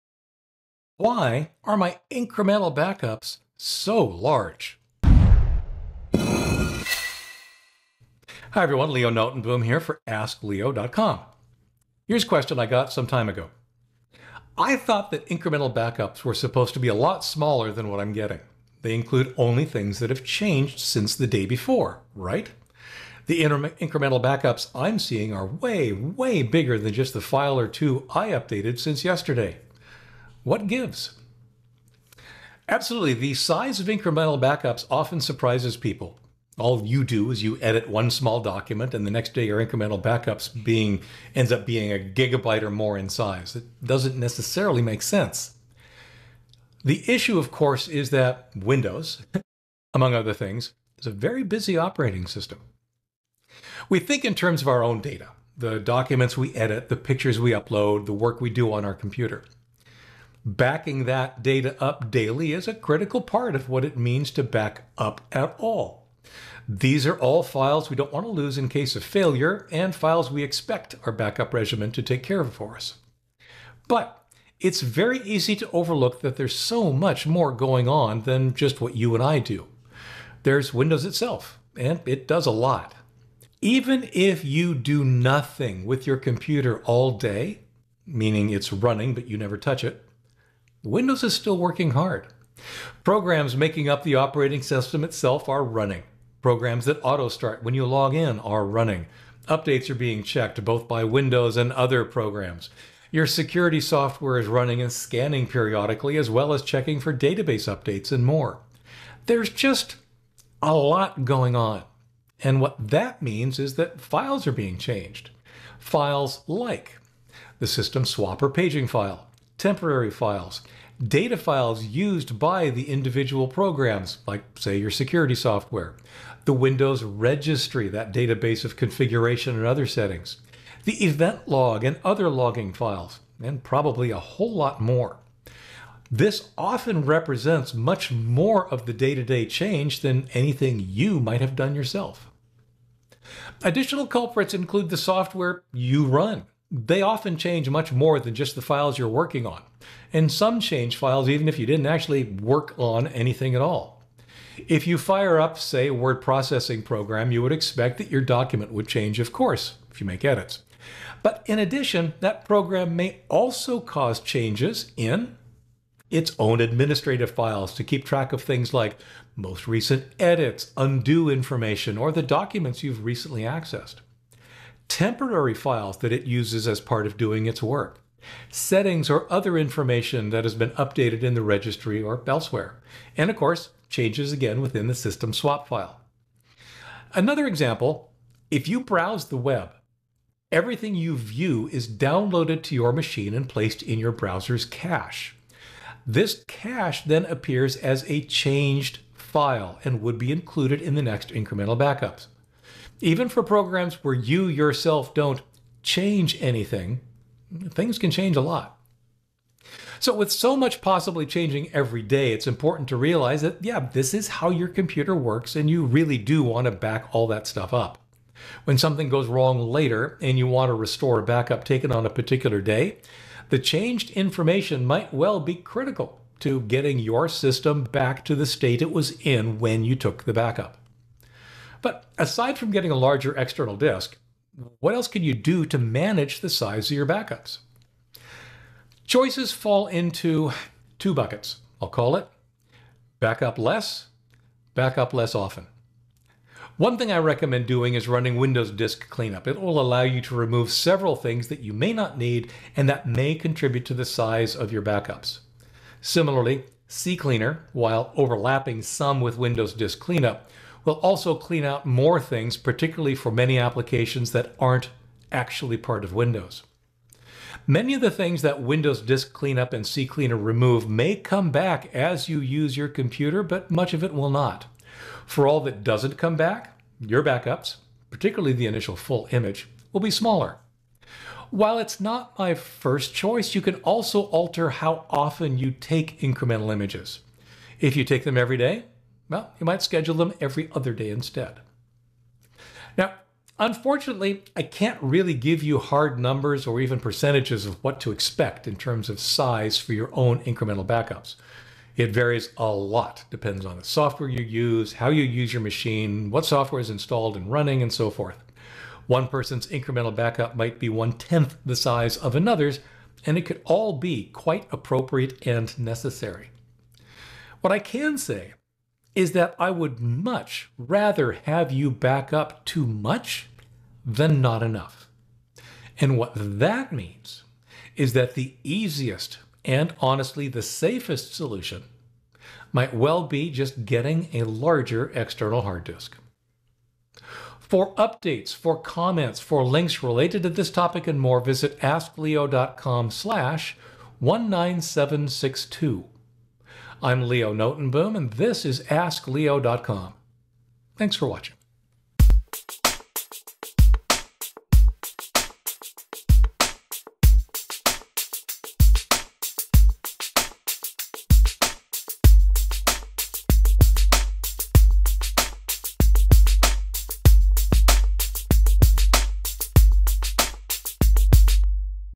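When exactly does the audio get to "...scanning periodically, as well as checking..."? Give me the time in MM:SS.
01:44.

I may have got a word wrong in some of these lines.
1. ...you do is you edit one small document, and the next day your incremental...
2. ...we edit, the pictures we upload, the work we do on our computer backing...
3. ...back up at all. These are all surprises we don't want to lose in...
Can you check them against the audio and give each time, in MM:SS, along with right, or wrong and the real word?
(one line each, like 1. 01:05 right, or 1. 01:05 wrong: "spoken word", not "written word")
1. 00:36 right
2. 00:56 right
3. 01:04 wrong: "files", not "surprises".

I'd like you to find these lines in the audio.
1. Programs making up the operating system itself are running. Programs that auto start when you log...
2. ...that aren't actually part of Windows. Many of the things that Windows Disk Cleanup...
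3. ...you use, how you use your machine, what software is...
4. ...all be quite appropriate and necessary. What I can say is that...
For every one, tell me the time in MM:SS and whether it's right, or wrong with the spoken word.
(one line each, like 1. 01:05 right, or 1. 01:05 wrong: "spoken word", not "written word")
1. 01:33 right
2. 04:24 right
3. 05:04 right
4. 05:13 right.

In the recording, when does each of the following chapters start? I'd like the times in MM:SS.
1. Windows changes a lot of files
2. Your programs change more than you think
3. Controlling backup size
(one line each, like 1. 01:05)
1. 01:20
2. 02:20
3. 03:30.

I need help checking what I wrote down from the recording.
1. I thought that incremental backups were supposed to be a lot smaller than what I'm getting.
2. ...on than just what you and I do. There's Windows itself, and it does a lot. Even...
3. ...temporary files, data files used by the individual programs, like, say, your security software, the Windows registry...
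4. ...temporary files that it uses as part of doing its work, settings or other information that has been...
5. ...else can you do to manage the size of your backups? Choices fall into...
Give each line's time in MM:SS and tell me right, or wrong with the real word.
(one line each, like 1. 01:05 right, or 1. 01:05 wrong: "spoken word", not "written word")
1. 00:14 right
2. 01:17 right
3. 01:59 right
4. 02:54 right
5. 03:54 right.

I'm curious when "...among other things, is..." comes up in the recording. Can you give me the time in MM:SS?
00:49.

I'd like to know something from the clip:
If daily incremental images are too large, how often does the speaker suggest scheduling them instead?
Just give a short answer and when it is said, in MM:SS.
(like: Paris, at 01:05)
every other day, at 04:50.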